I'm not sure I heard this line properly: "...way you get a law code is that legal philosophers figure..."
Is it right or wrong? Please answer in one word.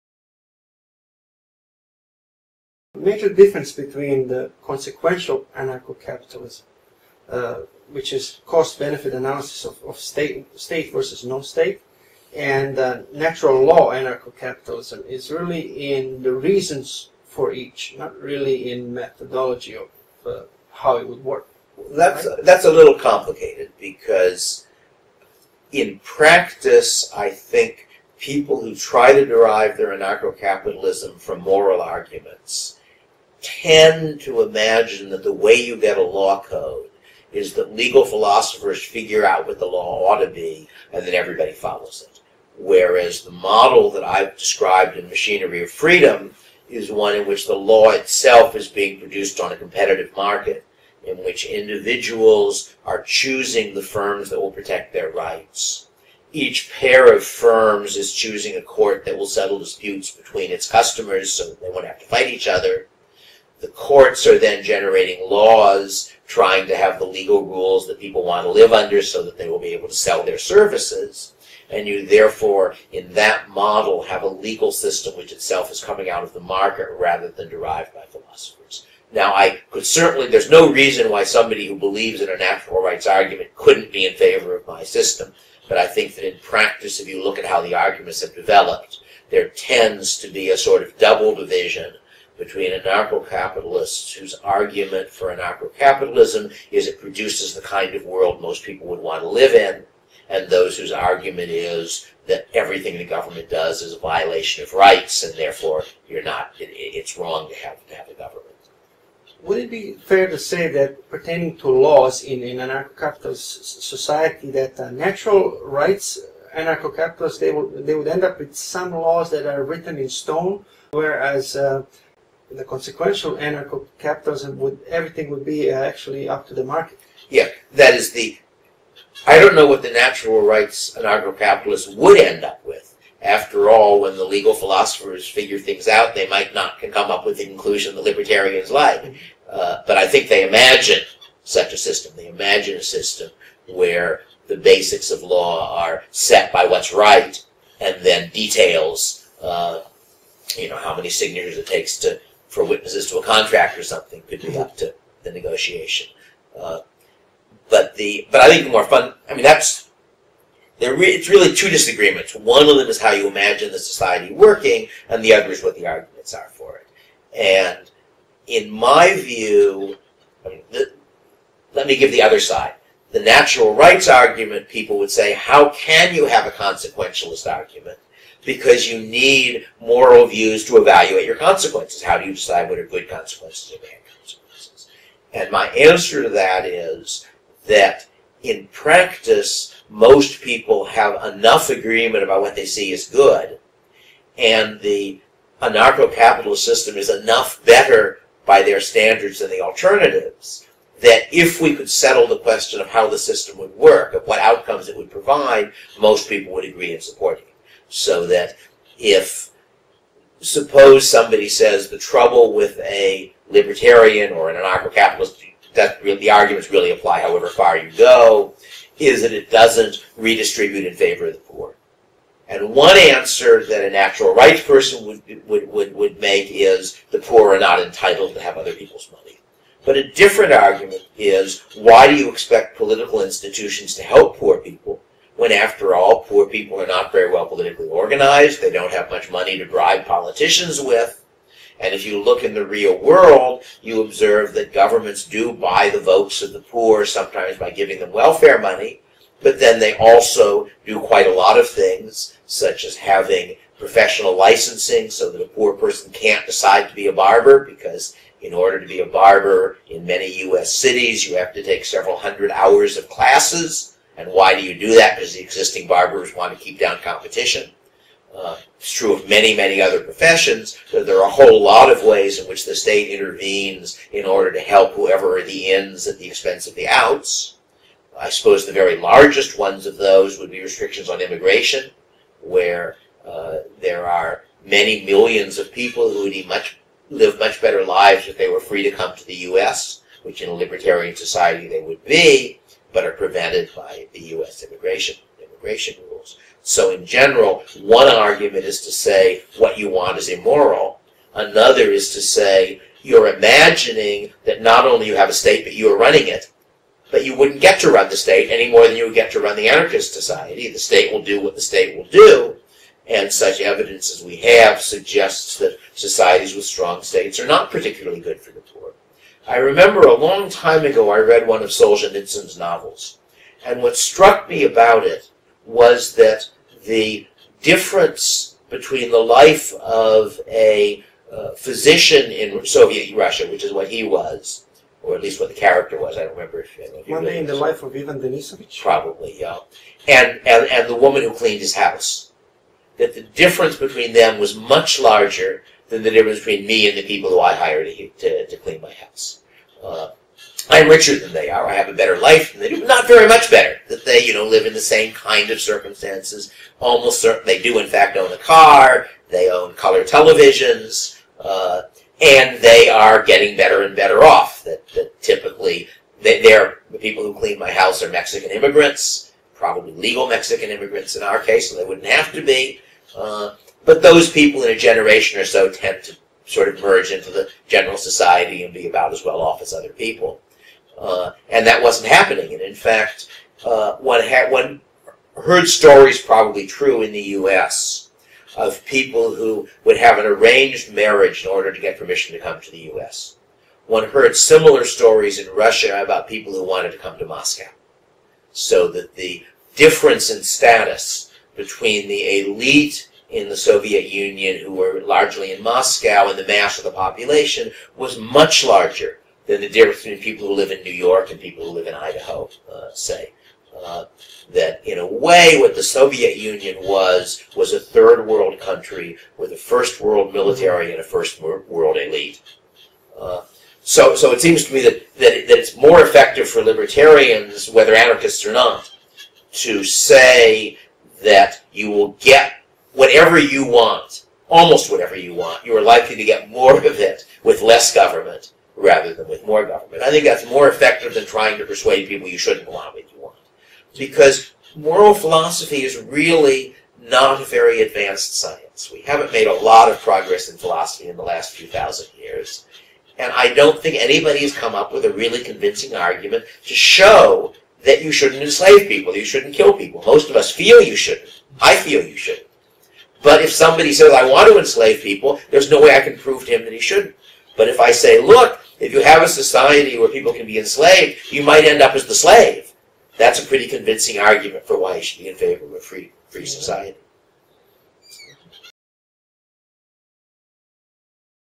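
right.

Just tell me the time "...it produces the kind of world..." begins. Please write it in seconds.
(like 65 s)
96 s.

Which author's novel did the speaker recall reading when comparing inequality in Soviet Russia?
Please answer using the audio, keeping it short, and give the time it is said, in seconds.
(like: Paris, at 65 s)
Solzhenitsyn, at 321 s.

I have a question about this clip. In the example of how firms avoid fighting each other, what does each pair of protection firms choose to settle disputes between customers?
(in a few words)
A court.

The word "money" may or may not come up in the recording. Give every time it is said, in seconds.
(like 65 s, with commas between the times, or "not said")
229 s, 239 s, 248 s.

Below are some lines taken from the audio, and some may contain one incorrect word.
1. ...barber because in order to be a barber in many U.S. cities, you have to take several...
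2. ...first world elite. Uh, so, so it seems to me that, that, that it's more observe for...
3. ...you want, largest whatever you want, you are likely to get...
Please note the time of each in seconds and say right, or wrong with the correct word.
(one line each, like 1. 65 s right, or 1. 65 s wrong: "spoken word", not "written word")
1. 257 s right
2. 421 s wrong: "effective", not "observe"
3. 433 s wrong: "almost", not "largest".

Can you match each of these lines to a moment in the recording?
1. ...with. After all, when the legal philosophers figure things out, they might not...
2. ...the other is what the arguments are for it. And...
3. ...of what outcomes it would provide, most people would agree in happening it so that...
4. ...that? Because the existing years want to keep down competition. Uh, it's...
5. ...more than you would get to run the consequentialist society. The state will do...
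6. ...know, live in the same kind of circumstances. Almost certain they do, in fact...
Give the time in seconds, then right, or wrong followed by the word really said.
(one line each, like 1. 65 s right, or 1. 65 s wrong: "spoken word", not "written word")
1. 132 s right
2. 165 s right
3. 204 s wrong: "supporting", not "happening"
4. 264 s wrong: "barbers", not "years"
5. 308 s wrong: "anarchist", not "consequentialist"
6. 354 s right.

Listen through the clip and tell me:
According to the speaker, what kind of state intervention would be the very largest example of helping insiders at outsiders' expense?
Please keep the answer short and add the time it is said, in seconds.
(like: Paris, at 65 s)
Restrictions on immigration, at 280 s.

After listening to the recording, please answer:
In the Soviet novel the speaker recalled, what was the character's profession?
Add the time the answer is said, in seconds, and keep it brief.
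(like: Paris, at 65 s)
Physician, at 331 s.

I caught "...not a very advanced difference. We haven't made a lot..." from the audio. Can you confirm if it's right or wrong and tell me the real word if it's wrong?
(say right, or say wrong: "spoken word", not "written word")
wrong: "science", not "difference".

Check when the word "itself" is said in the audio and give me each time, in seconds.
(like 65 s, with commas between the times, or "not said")
47 s, 75 s.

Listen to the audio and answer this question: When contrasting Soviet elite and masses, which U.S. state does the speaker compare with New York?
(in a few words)
Idaho.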